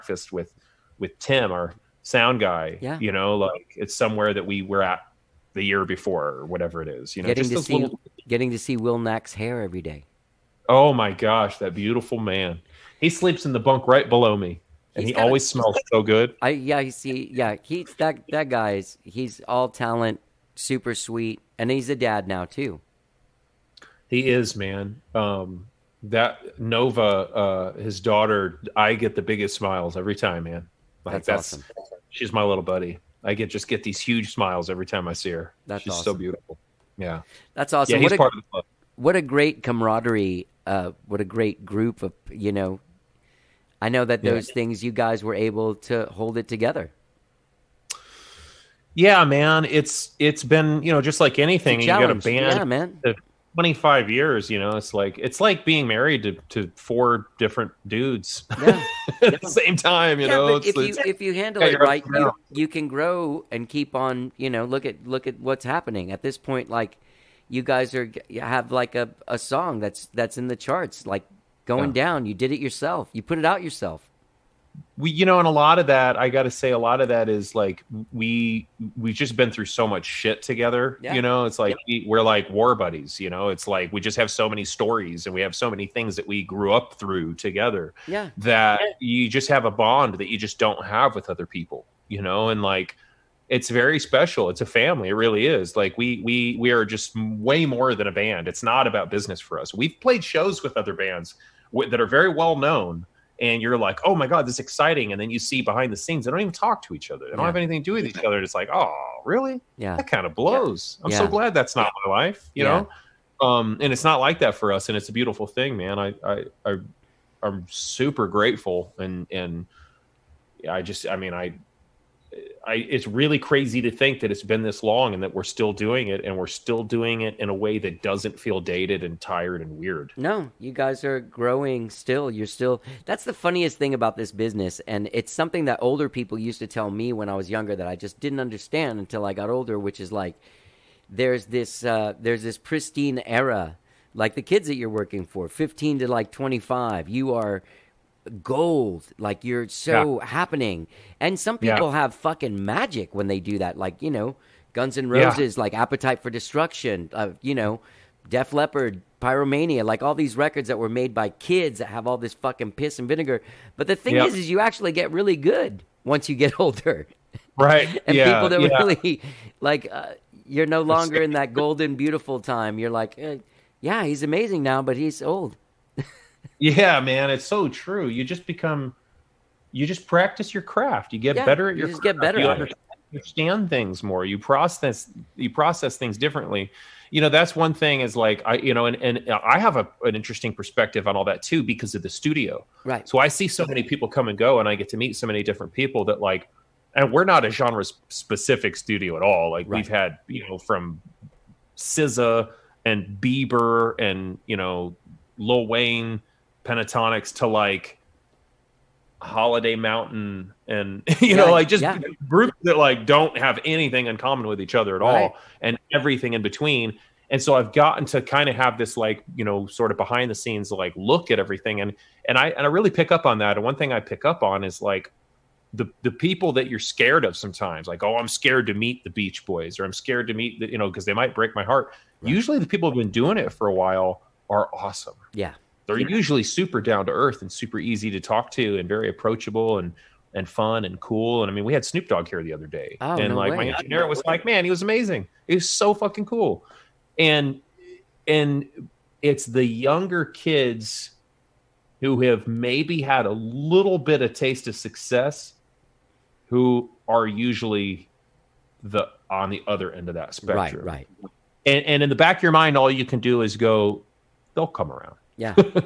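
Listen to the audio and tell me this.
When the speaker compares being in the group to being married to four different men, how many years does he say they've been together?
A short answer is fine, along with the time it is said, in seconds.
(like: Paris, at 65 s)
25, at 53 s.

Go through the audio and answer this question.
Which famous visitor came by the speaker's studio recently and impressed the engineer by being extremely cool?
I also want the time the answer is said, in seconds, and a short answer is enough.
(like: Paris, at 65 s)
Snoop Dogg, at 241 s.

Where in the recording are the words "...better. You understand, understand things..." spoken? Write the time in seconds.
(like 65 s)
182 s.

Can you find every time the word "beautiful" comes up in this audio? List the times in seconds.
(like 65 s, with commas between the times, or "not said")
11 s, 36 s, 115 s, 171 s.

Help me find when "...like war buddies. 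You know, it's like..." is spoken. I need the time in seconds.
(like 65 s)
82 s.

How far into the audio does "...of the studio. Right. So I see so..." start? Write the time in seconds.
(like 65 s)
191 s.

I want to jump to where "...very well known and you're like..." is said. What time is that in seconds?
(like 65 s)
102 s.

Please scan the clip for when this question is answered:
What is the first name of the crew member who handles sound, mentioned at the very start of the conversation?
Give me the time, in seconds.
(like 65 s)
1 s.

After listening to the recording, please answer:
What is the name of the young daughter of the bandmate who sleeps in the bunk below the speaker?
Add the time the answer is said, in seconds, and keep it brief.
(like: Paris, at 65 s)
Nova, at 26 s.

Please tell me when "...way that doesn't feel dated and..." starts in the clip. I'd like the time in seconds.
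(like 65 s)
127 s.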